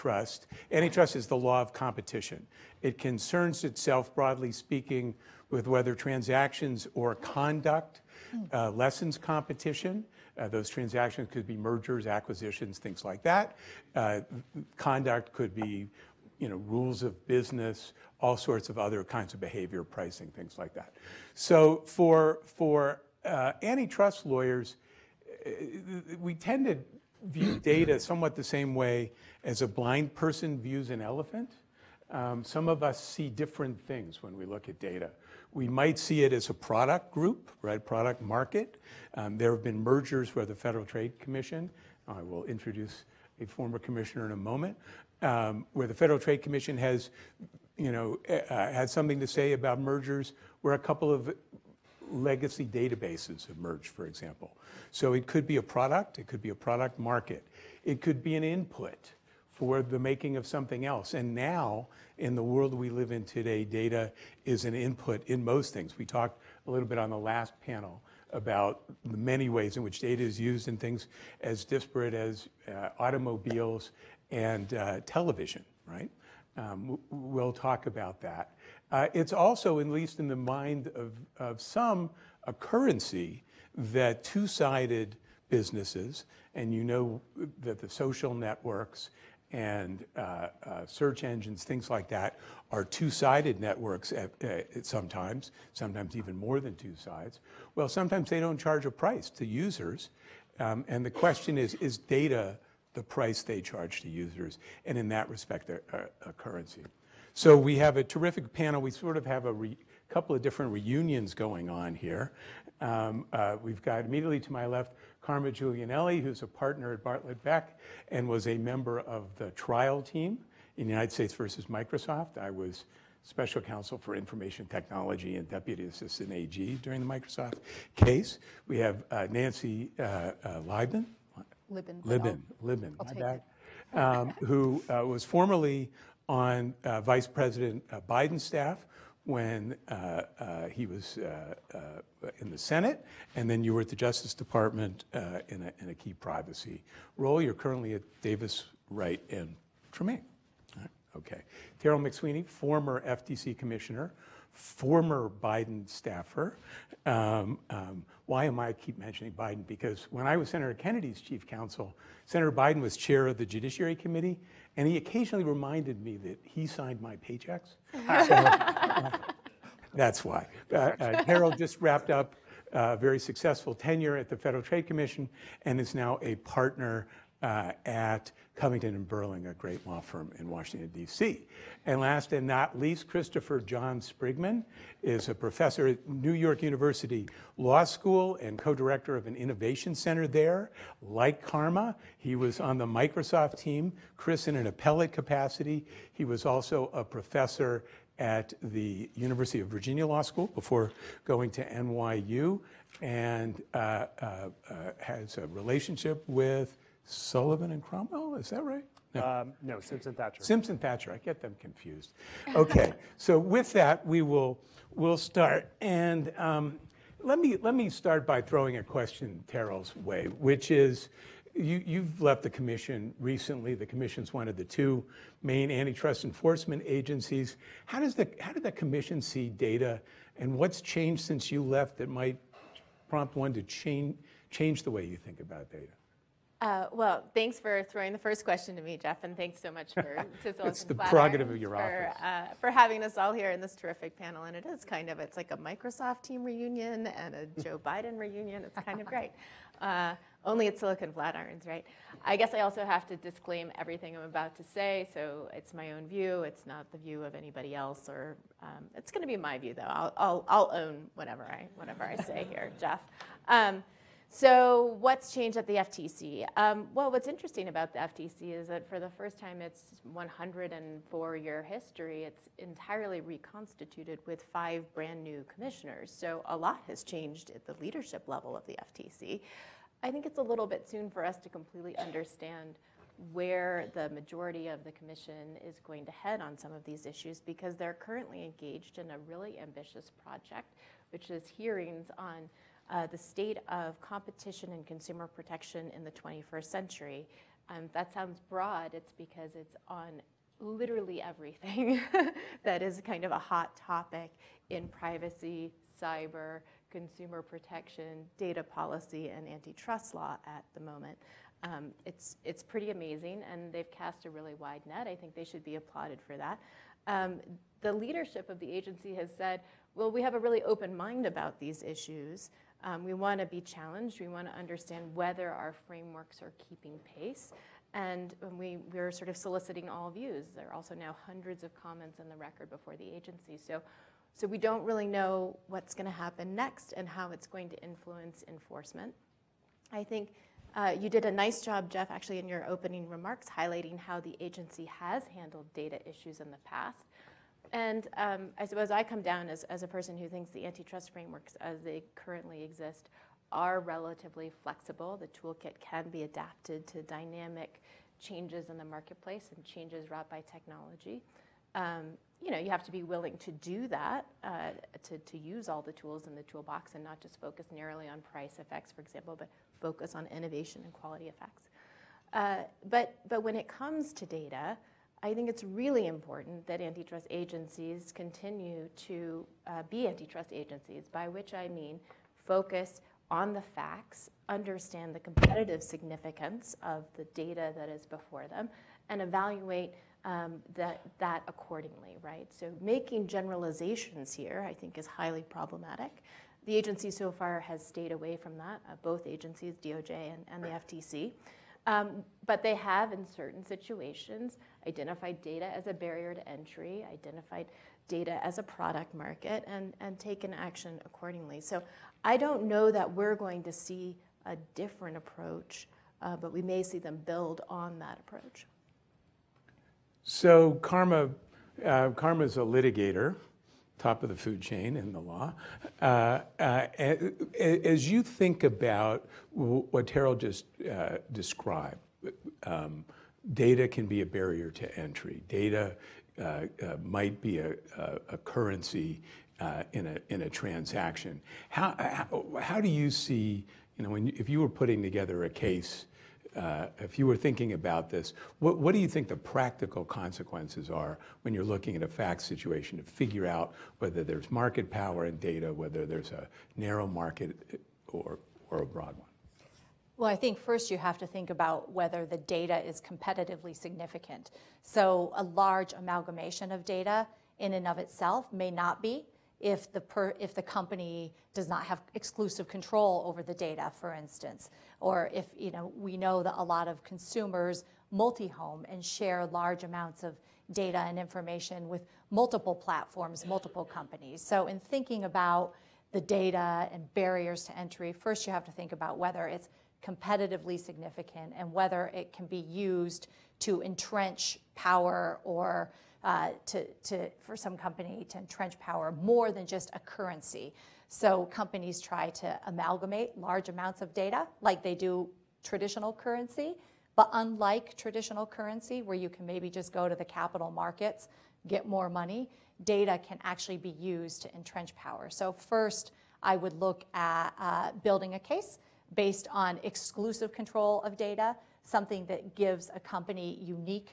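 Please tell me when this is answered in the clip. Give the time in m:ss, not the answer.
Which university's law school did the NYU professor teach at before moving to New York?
3:19.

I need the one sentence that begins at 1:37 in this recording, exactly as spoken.
Well, sometimes they don't charge a price to users.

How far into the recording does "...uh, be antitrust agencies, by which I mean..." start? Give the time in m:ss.
6:19.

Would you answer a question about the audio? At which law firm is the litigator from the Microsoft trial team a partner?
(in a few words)
Bartlit Beck.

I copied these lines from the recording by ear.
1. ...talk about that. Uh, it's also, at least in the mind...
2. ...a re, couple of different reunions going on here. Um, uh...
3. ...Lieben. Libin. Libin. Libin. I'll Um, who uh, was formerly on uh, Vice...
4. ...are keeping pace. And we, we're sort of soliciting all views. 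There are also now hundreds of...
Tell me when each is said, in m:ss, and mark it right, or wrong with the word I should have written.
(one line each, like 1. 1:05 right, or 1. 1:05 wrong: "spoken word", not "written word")
1. 1:17 right
2. 1:49 right
3. 2:10 right
4. 5:26 right.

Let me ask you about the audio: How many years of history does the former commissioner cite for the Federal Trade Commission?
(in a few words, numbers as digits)
104.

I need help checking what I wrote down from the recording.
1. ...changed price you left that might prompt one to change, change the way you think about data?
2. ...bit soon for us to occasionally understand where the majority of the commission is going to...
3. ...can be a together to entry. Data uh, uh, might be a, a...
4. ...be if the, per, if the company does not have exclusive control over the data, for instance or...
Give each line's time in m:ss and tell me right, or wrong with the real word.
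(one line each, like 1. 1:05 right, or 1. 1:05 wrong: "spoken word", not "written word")
1. 3:50 wrong: "since", not "price"
2. 4:40 wrong: "completely", not "occasionally"
3. 7:13 wrong: "barrier", not "together"
4. 7:49 right.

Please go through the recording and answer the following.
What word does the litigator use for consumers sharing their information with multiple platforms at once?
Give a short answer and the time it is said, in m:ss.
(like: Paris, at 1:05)
multi-home, at 7:58.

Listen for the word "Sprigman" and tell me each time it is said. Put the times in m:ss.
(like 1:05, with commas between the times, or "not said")
3:03.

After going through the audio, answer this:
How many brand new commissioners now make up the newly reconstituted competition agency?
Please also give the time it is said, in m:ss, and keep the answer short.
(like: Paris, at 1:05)
5, at 4:34.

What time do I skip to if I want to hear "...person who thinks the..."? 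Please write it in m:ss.
5:49.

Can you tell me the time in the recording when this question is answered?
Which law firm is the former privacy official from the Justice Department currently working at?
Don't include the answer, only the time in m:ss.
2:28.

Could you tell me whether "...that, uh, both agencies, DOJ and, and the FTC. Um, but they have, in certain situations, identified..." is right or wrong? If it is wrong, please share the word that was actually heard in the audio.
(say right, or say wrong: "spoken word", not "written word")
right.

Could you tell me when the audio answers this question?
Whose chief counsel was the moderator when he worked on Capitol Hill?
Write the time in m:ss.
2:40.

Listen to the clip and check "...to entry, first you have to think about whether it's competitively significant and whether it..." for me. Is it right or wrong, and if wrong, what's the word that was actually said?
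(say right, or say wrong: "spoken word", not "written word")
right.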